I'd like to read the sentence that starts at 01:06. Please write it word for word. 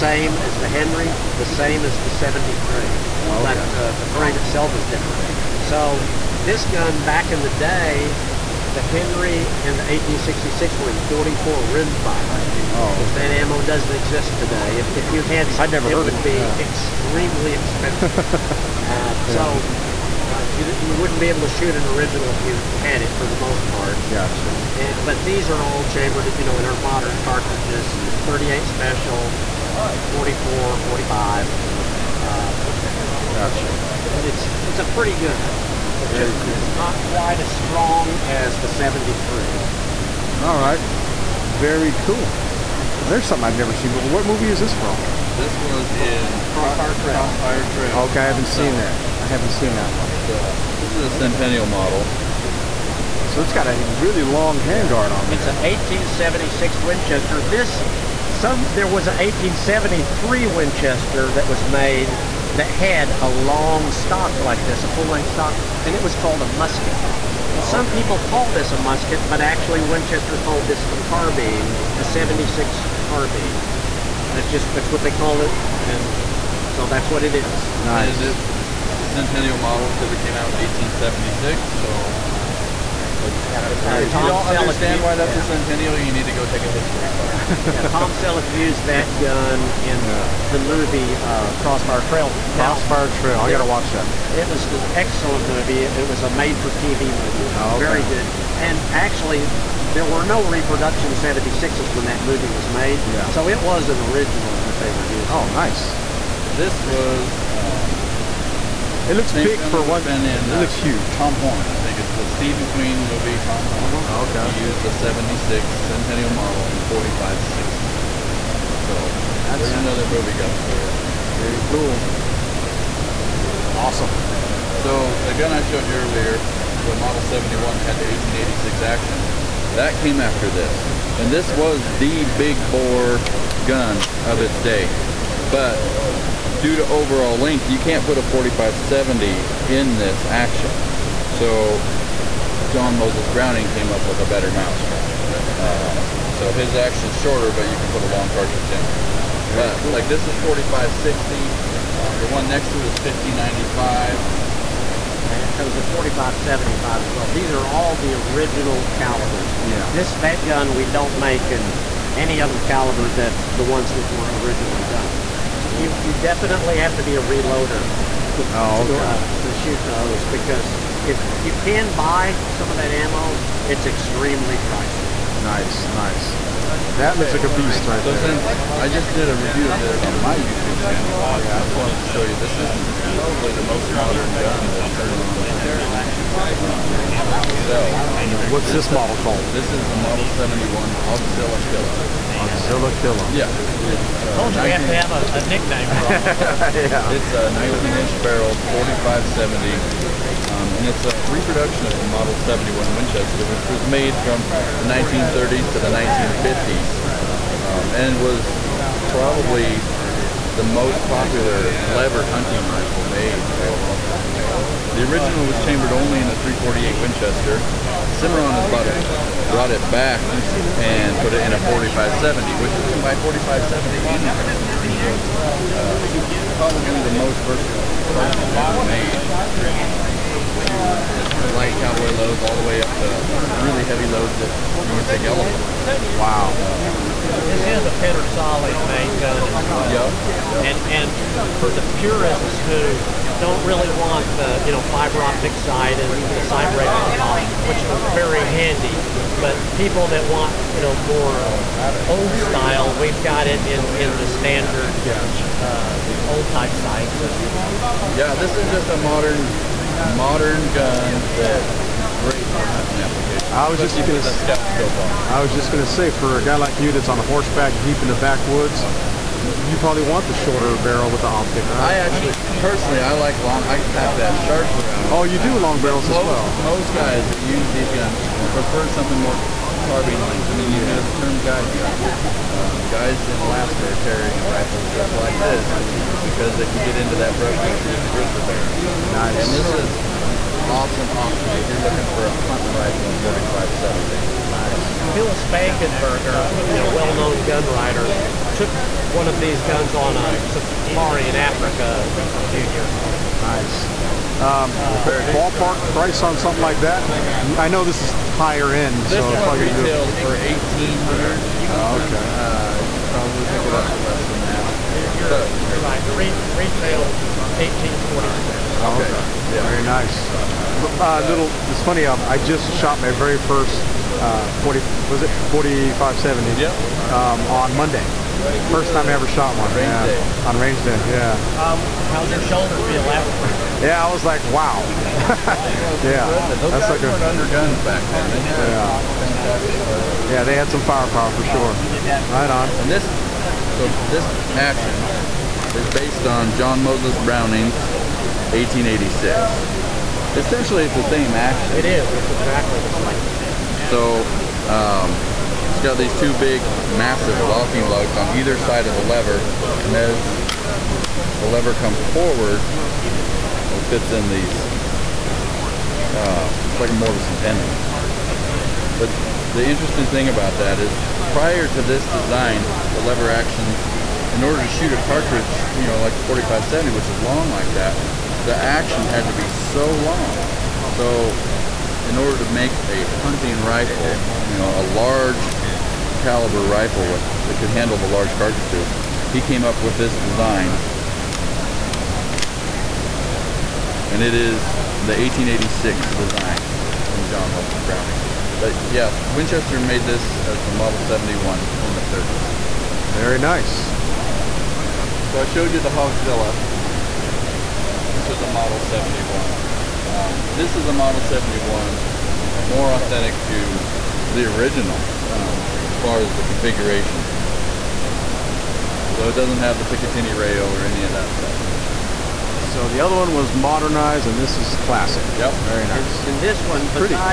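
Oh, some people call this a musket, but actually Winchester called this a carbine, a 76 carbine.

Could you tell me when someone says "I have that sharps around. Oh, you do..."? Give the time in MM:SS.
04:33.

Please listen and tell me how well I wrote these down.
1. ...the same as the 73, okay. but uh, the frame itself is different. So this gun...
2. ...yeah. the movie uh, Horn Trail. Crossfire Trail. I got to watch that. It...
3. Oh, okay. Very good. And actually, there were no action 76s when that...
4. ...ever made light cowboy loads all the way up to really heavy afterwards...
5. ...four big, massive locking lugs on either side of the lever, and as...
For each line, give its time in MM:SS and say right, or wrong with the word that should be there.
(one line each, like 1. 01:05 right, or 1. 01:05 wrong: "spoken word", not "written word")
1. 00:01 right
2. 01:30 wrong: "Crossfire", not "Horn"
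3. 01:37 wrong: "reproduction", not "action"
4. 03:48 wrong: "loads", not "afterwards"
5. 05:56 wrong: "two", not "four".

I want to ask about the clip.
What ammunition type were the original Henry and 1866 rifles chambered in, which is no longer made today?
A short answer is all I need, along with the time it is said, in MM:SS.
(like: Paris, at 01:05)
44 rimfire, at 00:11.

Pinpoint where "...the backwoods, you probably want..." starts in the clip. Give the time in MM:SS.
04:28.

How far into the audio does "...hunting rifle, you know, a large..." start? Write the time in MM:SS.
06:23.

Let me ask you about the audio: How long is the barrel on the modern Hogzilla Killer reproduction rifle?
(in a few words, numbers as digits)
19 inches.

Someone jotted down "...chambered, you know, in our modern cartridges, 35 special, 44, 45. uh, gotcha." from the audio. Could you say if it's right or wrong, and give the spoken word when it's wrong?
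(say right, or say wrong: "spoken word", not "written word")
wrong: "38", not "35".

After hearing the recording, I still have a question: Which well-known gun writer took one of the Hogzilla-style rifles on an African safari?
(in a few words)
Phil Spangenberger.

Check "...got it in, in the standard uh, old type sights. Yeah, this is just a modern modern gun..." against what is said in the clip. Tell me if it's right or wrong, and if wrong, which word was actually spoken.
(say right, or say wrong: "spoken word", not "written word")
right.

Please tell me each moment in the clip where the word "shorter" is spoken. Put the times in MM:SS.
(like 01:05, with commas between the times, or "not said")
02:27, 04:30.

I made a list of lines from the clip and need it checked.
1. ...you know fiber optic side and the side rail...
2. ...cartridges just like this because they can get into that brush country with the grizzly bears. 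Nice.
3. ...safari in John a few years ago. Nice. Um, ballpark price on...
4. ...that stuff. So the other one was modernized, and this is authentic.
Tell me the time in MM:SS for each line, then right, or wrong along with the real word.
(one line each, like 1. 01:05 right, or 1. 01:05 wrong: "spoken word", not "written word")
1. 04:04 right
2. 04:44 wrong: "rifles", not "cartridges"
3. 05:00 wrong: "Africa", not "John"
4. 07:01 wrong: "classic", not "authentic".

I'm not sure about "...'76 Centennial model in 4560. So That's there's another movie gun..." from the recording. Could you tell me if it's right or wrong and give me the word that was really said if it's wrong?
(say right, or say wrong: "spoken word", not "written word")
right.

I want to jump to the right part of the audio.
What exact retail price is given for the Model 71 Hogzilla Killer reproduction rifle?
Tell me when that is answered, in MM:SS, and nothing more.
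05:17.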